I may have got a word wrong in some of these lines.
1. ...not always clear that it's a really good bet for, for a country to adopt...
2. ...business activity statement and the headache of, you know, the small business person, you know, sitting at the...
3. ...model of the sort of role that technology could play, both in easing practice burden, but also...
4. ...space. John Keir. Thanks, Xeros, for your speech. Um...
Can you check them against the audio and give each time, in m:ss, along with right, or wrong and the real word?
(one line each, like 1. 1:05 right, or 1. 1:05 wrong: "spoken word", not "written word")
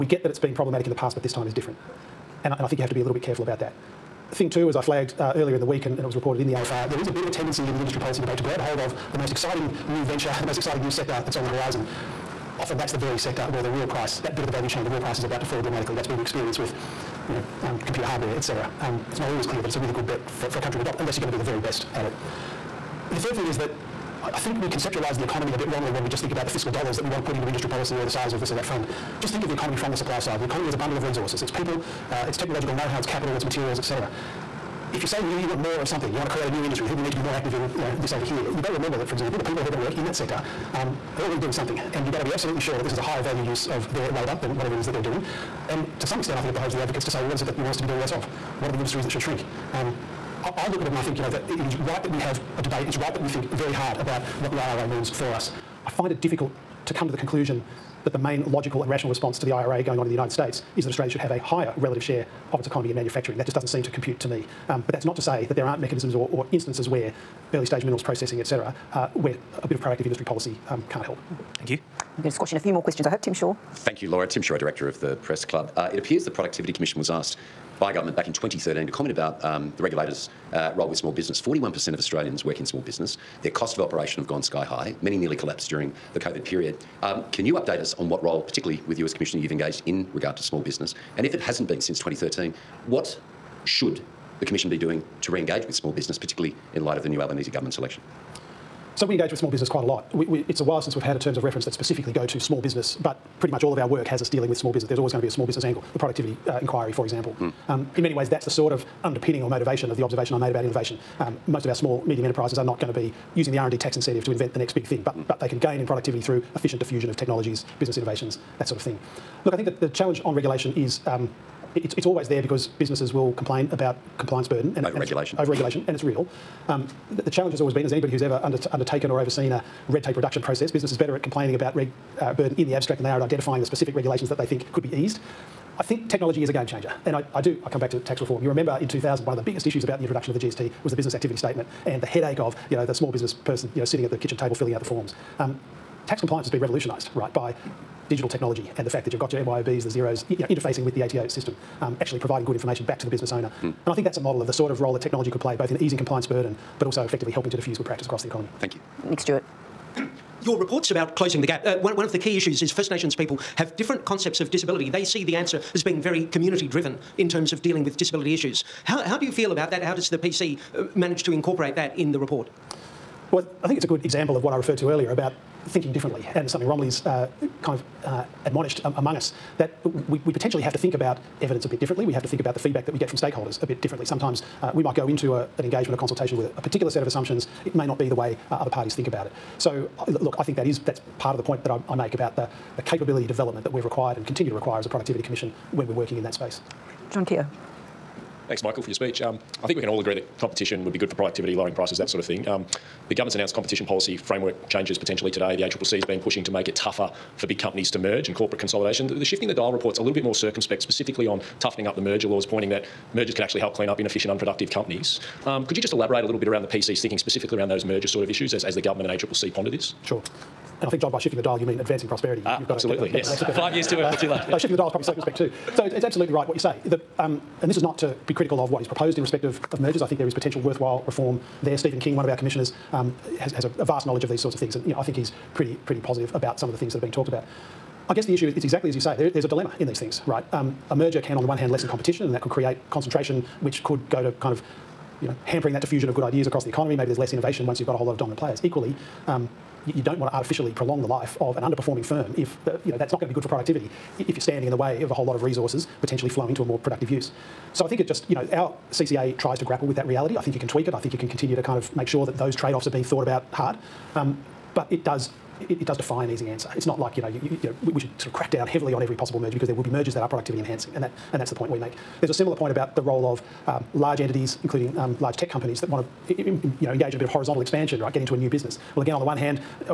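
1. 0:19 right
2. 2:20 right
3. 2:34 wrong: "compliance", not "practice"
4. 3:16 wrong: "Michael", not "Xeros".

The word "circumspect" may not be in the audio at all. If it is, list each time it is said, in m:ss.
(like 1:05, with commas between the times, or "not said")
3:30, 3:45.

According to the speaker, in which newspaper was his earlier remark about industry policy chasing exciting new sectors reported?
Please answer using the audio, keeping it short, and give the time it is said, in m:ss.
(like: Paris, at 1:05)
AFR, at 0:06.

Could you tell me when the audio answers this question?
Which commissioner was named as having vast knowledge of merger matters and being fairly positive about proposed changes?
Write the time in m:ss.
3:51.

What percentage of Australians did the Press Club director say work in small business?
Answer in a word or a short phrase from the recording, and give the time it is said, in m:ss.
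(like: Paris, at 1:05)
41%, at 1:21.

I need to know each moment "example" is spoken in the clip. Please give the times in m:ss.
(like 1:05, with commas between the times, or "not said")
0:39, 1:47, 2:54.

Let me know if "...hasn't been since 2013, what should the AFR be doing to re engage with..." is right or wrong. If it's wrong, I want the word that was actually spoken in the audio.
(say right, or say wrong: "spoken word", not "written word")
wrong: "Commission", not "AFR".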